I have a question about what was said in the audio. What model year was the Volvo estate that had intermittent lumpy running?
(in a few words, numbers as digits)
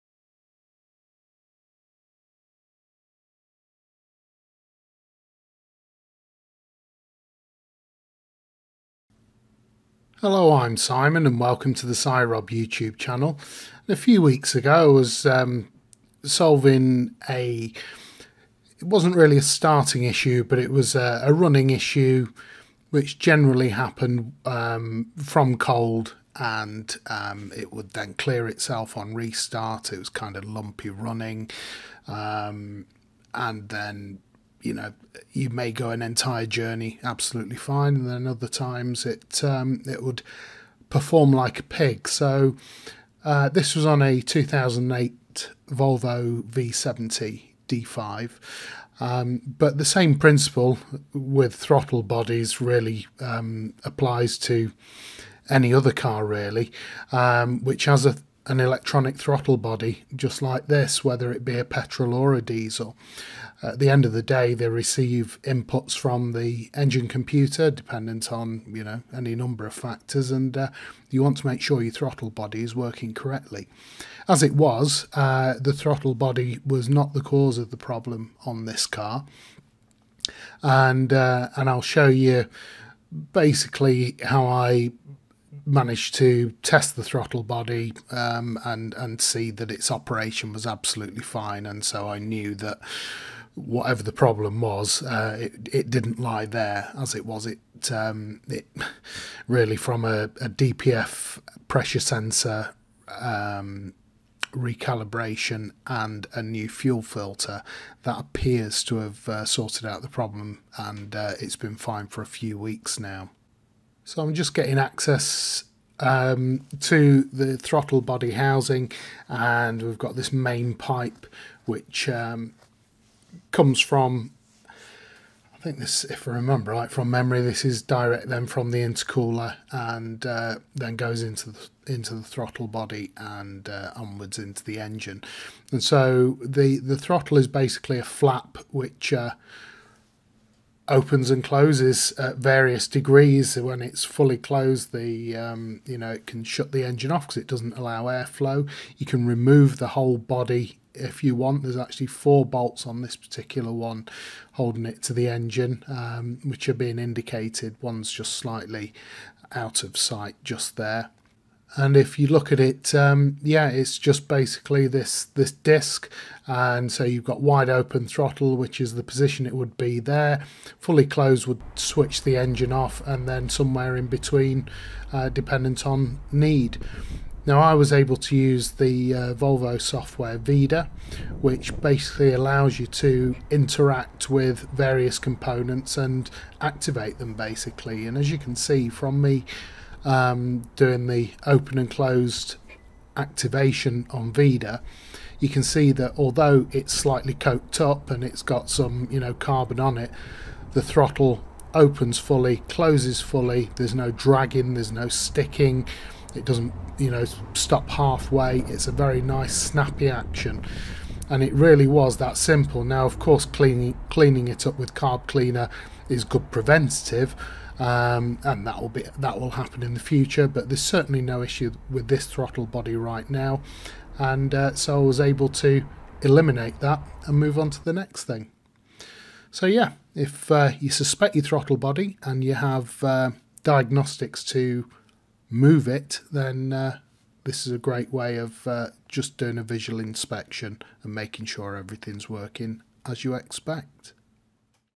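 2008.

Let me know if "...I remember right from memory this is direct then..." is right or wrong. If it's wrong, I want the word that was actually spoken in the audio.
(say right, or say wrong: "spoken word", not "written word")
right.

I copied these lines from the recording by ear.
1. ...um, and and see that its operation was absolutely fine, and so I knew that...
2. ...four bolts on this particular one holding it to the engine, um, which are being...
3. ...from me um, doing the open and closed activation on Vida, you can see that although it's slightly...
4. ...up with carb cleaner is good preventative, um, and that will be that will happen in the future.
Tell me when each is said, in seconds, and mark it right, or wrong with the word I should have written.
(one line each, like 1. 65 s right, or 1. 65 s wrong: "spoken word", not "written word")
1. 88 s right
2. 152 s right
3. 188 s right
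4. 214 s right.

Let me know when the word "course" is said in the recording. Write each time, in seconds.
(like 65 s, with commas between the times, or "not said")
213 s.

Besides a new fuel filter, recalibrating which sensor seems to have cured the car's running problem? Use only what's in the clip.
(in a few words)
DPF pressure sensor.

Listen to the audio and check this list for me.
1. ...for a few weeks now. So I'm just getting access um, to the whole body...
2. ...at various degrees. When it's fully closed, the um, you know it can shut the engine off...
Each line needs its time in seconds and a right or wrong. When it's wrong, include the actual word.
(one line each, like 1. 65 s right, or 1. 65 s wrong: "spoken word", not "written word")
1. 112 s wrong: "throttle", not "whole"
2. 142 s right.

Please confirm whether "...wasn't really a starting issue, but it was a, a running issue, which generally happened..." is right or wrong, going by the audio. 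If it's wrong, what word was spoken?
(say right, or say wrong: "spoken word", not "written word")
right.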